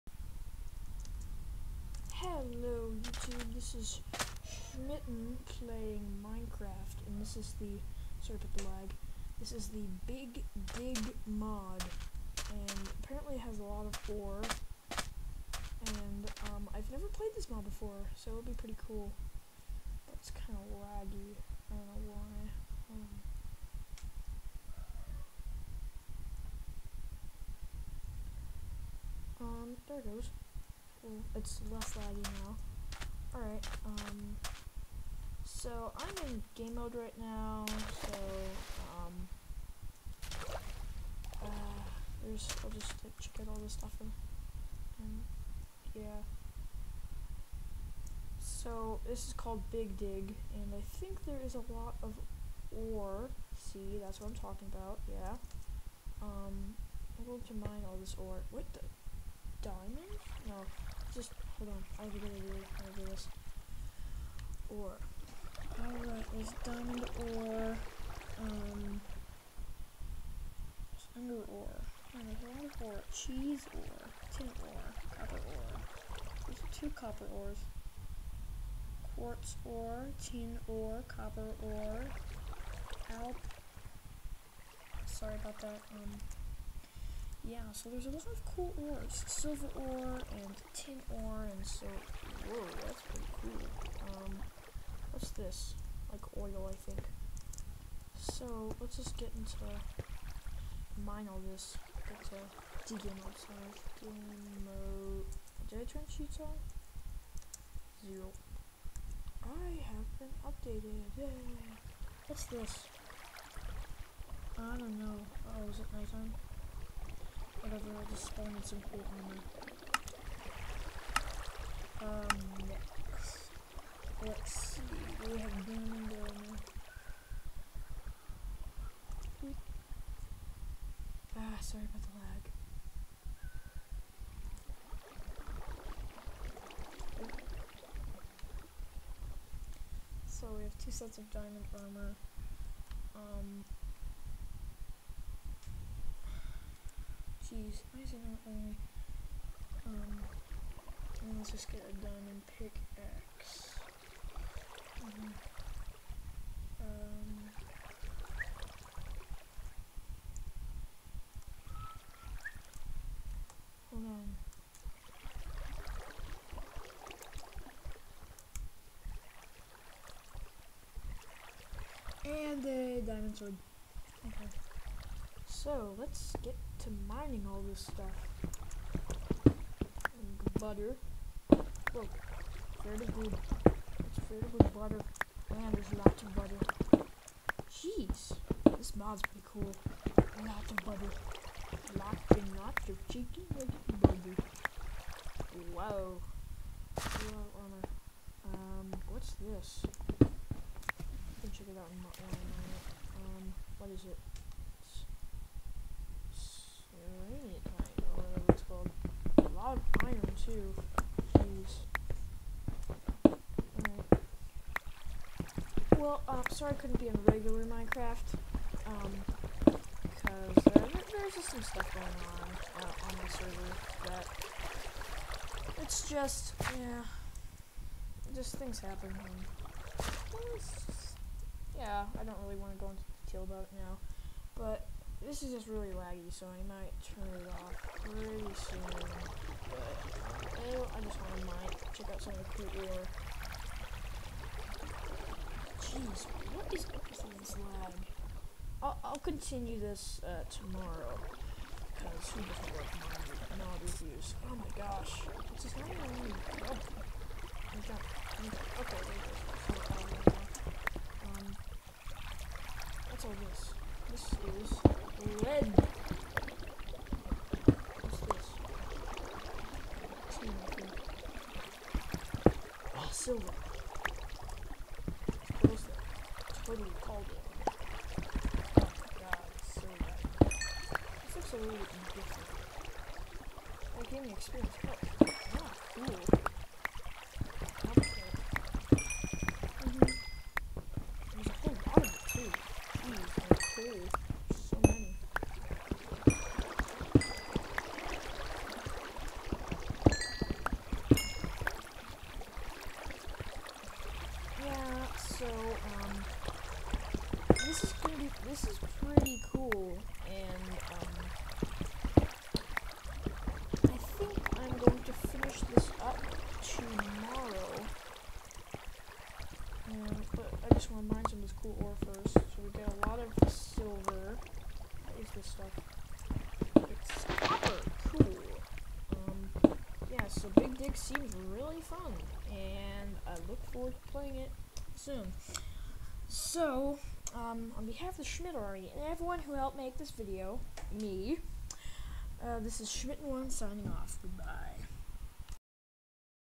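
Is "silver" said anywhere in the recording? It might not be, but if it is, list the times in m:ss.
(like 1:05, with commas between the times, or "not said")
1:29, 4:33, 5:23.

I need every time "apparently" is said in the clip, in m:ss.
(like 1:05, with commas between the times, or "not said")
0:13.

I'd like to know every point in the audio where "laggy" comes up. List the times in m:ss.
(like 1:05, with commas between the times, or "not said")
0:20, 0:31, 3:55.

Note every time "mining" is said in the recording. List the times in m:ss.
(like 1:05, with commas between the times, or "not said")
2:57, 4:13.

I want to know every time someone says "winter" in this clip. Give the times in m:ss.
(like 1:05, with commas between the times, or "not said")
not said.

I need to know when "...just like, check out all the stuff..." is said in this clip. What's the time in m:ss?
0:42.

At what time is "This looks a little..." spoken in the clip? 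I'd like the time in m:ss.
4:41.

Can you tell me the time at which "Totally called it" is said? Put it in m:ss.
4:36.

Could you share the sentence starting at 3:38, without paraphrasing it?
Um, because uh, there's just some stuff going on uh, on the server that it's just, yeah, just things happen.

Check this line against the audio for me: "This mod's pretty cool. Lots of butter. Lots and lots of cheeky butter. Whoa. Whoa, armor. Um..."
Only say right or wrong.
right.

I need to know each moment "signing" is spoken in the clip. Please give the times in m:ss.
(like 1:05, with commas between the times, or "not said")
5:43.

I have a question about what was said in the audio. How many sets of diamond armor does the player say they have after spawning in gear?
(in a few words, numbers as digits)
2.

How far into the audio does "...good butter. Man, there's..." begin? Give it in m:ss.
3:04.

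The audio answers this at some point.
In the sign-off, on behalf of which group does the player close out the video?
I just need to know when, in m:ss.
5:38.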